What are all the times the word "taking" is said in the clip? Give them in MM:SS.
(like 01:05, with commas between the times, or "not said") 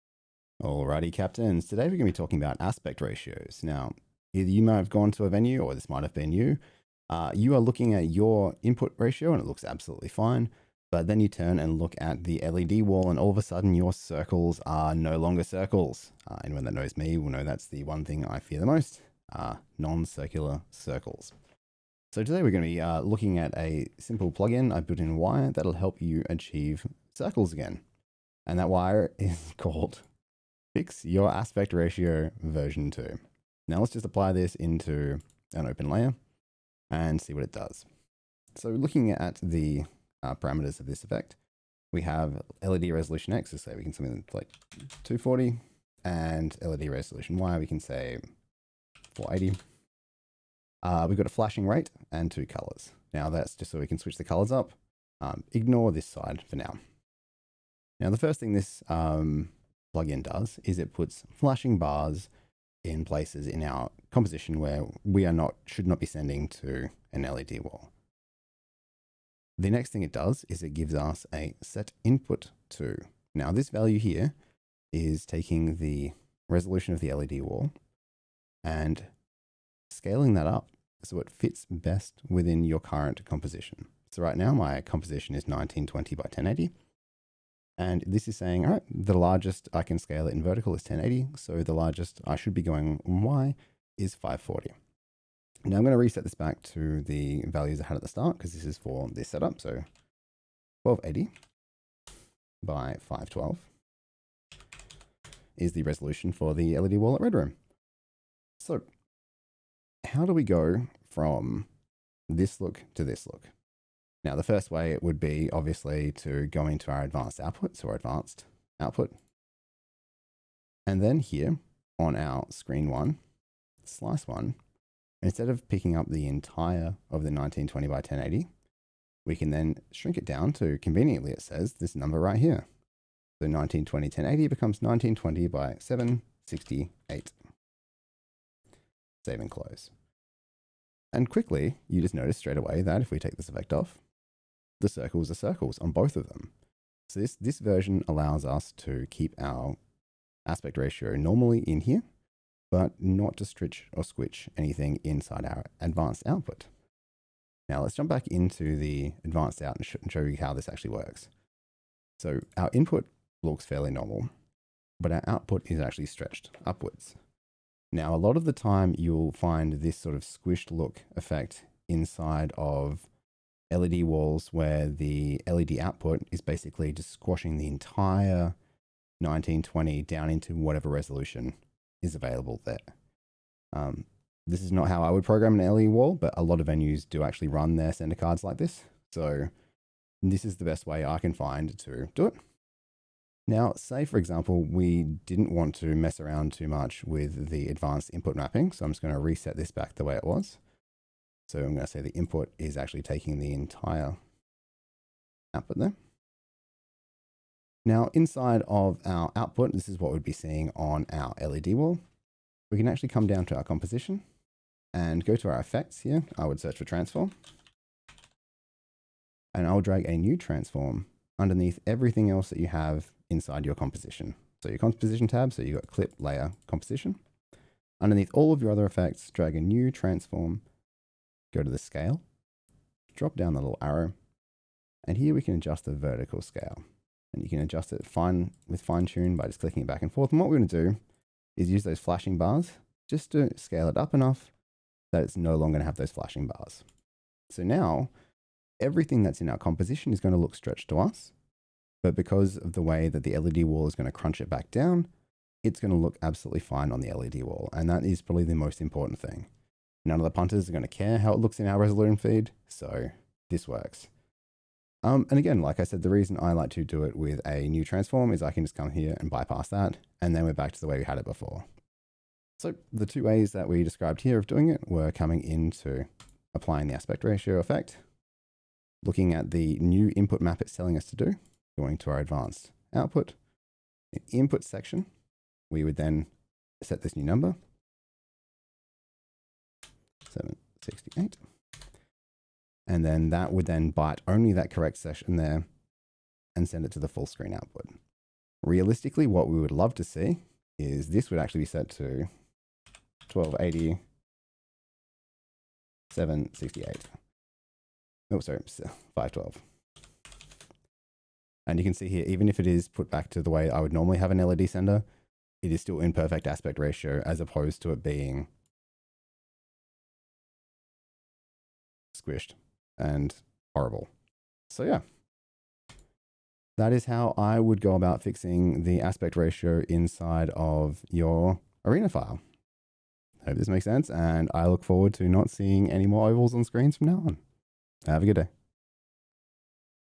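01:15, 03:23.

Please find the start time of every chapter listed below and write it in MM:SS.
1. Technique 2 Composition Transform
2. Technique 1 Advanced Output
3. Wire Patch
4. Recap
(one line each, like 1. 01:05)
1. 03:26
2. 01:52
3. 00:27
4. 04:32.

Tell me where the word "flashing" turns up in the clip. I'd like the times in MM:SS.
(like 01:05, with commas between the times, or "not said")
00:51, 01:01, 04:01, 04:06.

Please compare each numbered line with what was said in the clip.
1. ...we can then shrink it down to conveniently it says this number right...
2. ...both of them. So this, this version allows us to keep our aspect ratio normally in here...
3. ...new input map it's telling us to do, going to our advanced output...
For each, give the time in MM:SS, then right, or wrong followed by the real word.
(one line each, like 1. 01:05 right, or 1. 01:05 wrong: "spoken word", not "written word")
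1. 02:09 right
2. 02:25 right
3. 04:39 right.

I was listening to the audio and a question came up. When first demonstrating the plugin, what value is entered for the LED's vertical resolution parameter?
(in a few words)
480.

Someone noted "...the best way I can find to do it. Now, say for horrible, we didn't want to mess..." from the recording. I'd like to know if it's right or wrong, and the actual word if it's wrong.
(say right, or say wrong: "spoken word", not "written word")
wrong: "example", not "horrible".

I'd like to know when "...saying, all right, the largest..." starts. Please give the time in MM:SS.
01:28.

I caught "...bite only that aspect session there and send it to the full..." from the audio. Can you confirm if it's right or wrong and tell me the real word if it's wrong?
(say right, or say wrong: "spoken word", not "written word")
wrong: "correct", not "aspect".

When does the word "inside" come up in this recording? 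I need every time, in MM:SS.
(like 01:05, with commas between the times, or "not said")
02:35, 02:51, 03:28, 03:43, 05:29.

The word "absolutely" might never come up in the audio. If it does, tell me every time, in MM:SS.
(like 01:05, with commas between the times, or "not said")
00:09, 04:16.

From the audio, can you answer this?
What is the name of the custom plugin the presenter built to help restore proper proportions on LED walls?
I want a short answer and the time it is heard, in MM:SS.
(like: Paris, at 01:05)
Fix your aspect ratio version 2, at 00:30.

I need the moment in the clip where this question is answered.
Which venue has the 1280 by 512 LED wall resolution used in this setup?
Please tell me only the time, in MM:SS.
01:47.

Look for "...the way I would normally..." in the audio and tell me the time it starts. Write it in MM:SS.
05:13.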